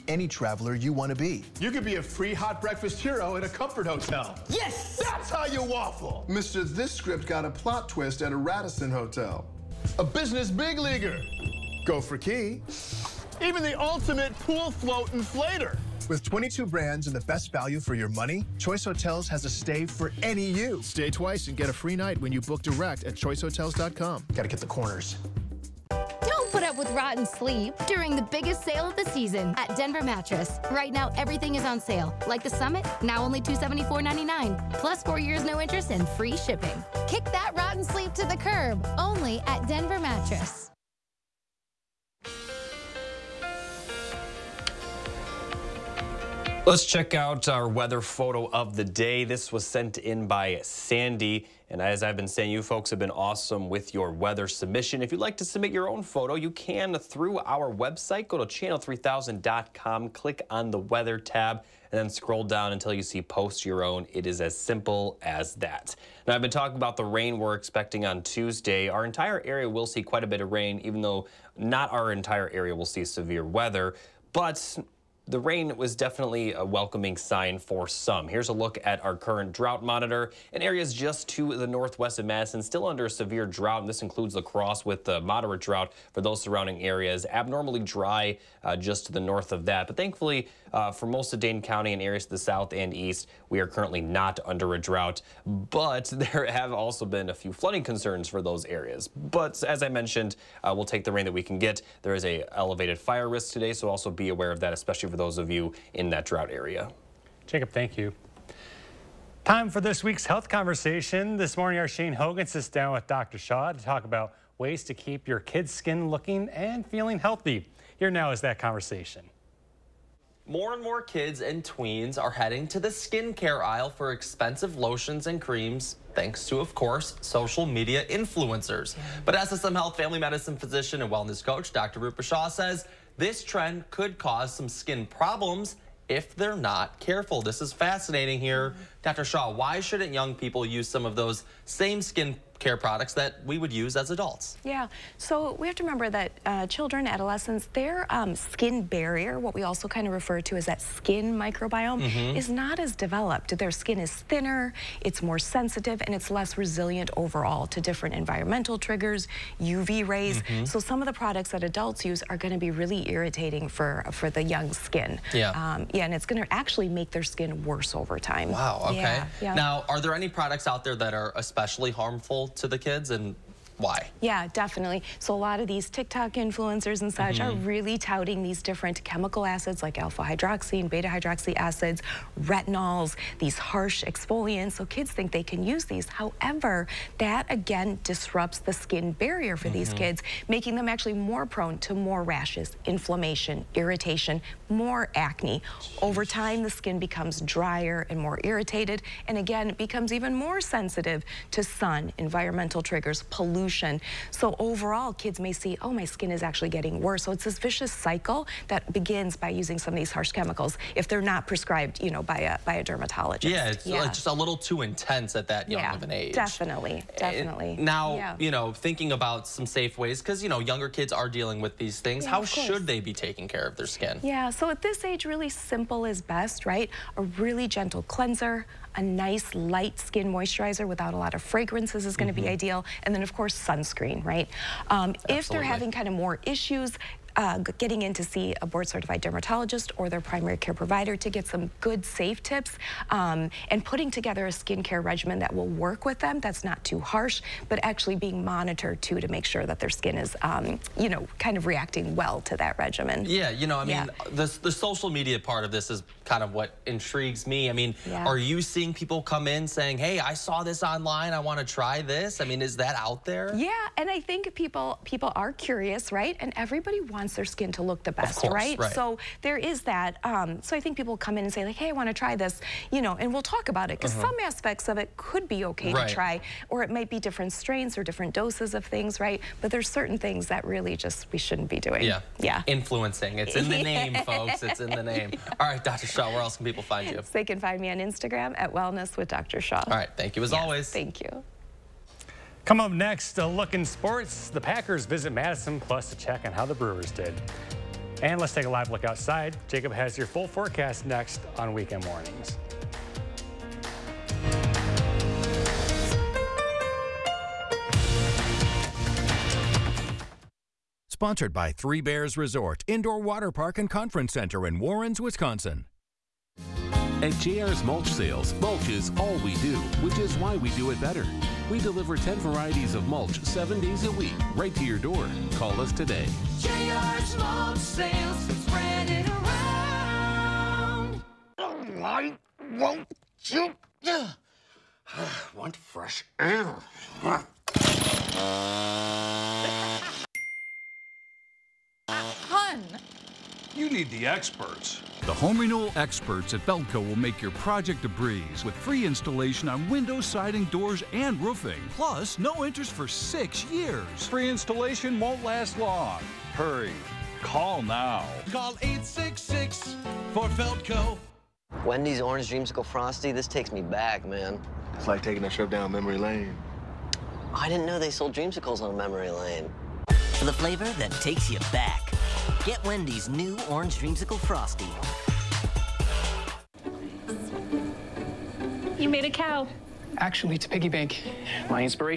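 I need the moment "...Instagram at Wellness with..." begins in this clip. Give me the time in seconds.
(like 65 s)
288 s.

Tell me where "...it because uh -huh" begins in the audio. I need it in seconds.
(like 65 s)
273 s.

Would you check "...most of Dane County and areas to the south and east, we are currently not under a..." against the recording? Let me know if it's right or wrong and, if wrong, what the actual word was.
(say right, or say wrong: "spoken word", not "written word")
right.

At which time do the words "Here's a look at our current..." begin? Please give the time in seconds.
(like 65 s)
78 s.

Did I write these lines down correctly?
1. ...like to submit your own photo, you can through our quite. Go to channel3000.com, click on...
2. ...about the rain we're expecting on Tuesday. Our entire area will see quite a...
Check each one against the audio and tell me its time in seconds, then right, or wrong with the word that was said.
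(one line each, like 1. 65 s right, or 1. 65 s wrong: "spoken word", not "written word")
1. 55 s wrong: "website", not "quite"
2. 66 s right.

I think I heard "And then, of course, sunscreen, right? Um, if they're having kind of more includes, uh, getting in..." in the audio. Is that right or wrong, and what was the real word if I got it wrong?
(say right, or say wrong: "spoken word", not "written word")
wrong: "issues", not "includes".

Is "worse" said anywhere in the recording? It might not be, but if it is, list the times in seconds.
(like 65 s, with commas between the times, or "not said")
167 s, 206 s.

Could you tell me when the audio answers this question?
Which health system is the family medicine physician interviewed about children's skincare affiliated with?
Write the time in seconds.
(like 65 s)
129 s.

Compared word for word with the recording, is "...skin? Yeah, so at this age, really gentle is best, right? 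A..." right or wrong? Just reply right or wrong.
wrong.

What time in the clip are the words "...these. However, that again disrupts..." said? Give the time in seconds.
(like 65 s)
185 s.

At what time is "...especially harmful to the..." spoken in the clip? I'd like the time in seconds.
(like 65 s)
171 s.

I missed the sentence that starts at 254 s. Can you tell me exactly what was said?
the, the social media part of this is kind of what intrigues me I mean yeah.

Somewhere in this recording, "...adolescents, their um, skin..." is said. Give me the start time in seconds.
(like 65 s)
147 s.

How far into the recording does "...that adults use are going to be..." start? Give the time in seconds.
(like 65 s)
161 s.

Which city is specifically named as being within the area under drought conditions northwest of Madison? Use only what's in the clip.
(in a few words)
La Crosse.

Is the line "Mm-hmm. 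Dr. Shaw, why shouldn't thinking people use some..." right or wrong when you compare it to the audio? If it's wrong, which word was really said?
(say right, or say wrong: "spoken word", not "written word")
wrong: "young", not "thinking".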